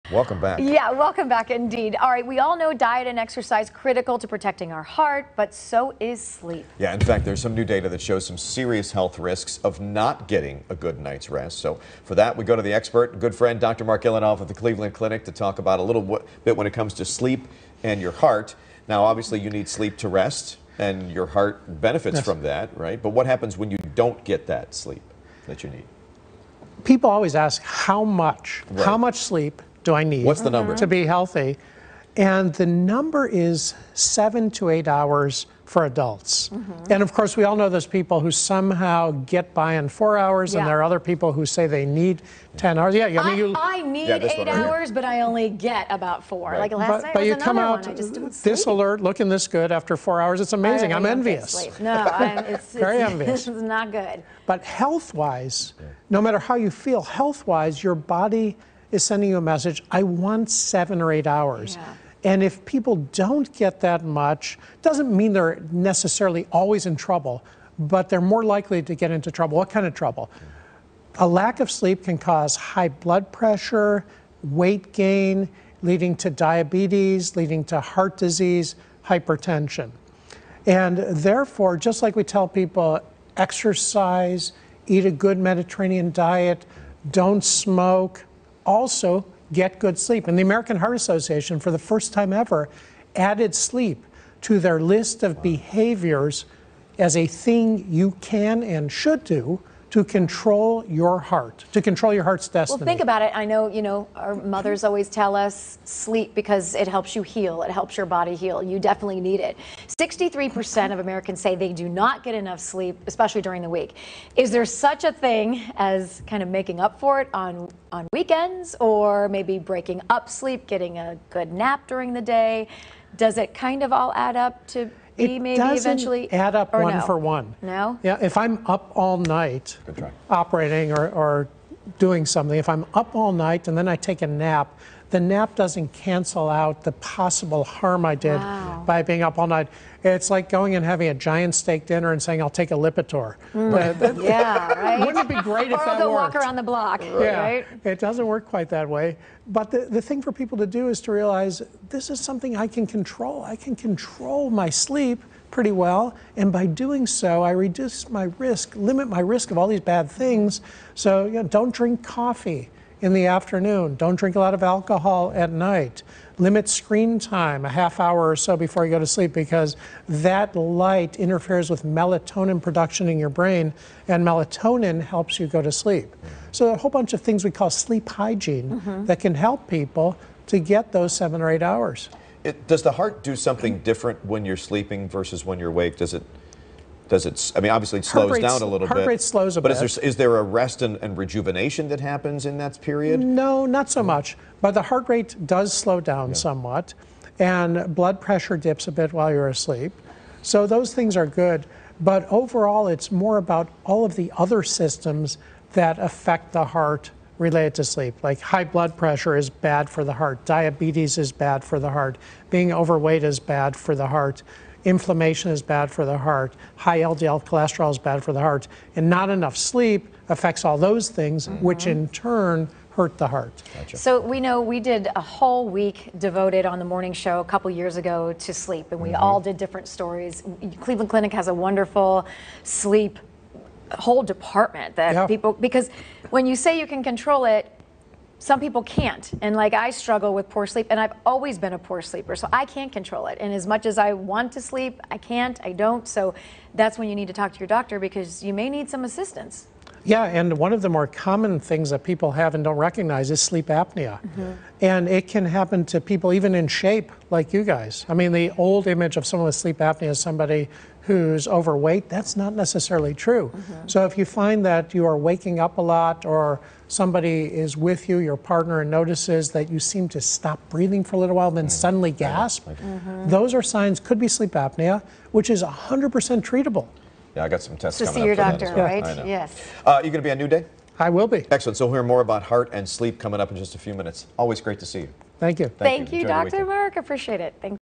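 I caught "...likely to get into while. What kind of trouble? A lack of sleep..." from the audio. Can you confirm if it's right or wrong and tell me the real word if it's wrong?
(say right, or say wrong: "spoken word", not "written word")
wrong: "trouble", not "while".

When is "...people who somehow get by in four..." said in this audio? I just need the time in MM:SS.
00:37.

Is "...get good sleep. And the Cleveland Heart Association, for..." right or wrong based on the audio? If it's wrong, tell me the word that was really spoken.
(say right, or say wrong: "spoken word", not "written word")
wrong: "American", not "Cleveland".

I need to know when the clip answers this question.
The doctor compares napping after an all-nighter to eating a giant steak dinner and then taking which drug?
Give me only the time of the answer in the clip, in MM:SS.
02:22.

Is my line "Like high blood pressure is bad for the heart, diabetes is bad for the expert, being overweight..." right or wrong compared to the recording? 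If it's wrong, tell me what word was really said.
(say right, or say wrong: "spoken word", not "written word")
wrong: "heart", not "expert".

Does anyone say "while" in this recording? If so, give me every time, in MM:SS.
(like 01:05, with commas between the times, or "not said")
03:19, 04:31.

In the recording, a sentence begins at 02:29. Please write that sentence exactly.
But the, the thing for people to do is to realize this is something I can control.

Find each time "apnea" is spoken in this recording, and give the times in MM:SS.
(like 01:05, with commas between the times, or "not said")
04:13, 04:19, 04:34.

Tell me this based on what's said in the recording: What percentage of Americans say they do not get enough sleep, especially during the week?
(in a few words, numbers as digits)
63%.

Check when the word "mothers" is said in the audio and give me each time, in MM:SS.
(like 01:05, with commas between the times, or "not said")
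01:44.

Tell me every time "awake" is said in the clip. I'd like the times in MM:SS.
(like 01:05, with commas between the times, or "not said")
03:05.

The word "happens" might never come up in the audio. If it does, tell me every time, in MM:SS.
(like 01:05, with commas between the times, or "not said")
00:23, 03:11, 04:15.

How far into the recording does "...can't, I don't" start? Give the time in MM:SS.
04:05.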